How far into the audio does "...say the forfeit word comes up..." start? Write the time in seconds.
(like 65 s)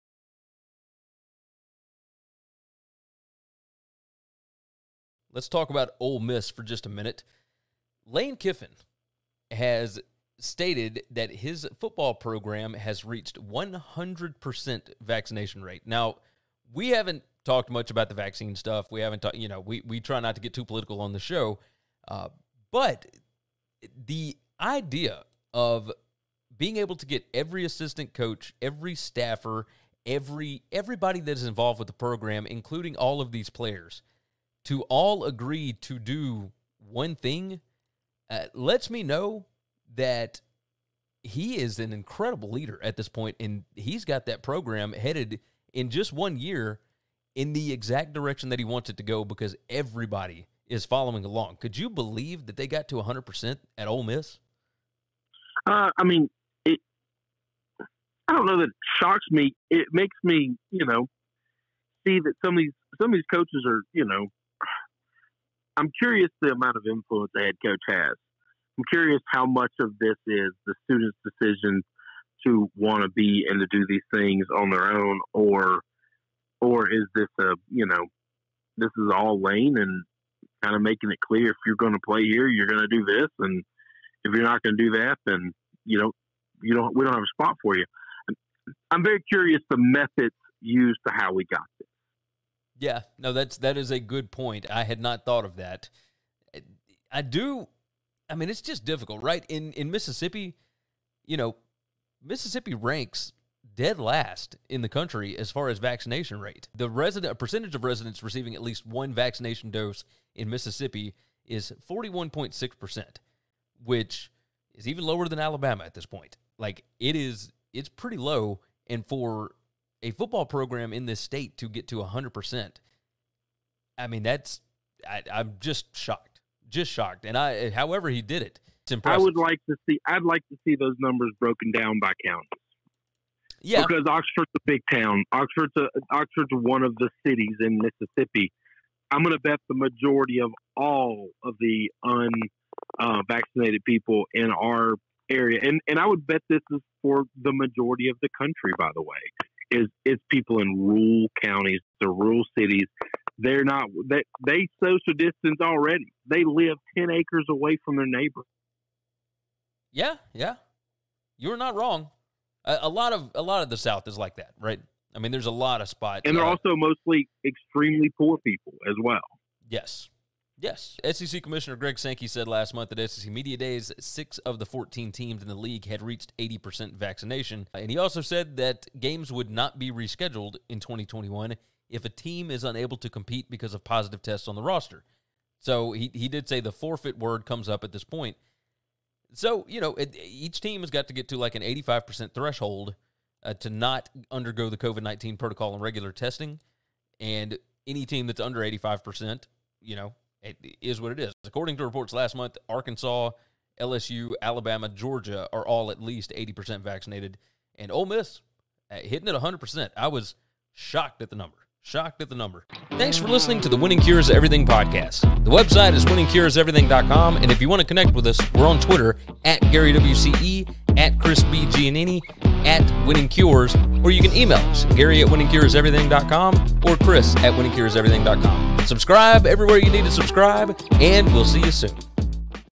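186 s.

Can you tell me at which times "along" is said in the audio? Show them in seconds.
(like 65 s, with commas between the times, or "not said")
51 s.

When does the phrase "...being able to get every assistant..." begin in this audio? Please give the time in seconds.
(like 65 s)
26 s.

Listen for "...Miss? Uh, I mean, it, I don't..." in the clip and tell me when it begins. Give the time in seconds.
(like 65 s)
54 s.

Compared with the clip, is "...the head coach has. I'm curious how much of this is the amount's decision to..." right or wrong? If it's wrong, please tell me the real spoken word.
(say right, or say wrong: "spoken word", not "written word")
wrong: "student", not "amount".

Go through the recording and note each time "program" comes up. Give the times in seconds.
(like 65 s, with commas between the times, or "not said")
12 s, 31 s, 44 s, 120 s.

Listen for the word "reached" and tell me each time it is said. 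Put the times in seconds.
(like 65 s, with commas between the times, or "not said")
13 s, 176 s.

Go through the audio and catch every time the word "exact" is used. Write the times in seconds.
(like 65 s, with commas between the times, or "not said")
47 s.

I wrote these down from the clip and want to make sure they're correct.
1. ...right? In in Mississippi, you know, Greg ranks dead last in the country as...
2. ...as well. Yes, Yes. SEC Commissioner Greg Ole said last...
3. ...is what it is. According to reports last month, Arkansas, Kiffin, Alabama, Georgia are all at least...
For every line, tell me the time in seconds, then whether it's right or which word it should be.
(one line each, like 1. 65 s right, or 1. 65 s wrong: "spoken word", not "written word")
1. 99 s wrong: "Mississippi", not "Greg"
2. 168 s wrong: "Sankey", not "Ole"
3. 200 s wrong: "LSU", not "Kiffin".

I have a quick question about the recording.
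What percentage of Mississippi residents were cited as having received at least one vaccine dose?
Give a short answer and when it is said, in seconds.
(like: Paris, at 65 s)
41.6%, at 111 s.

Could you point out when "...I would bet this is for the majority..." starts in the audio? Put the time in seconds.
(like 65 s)
145 s.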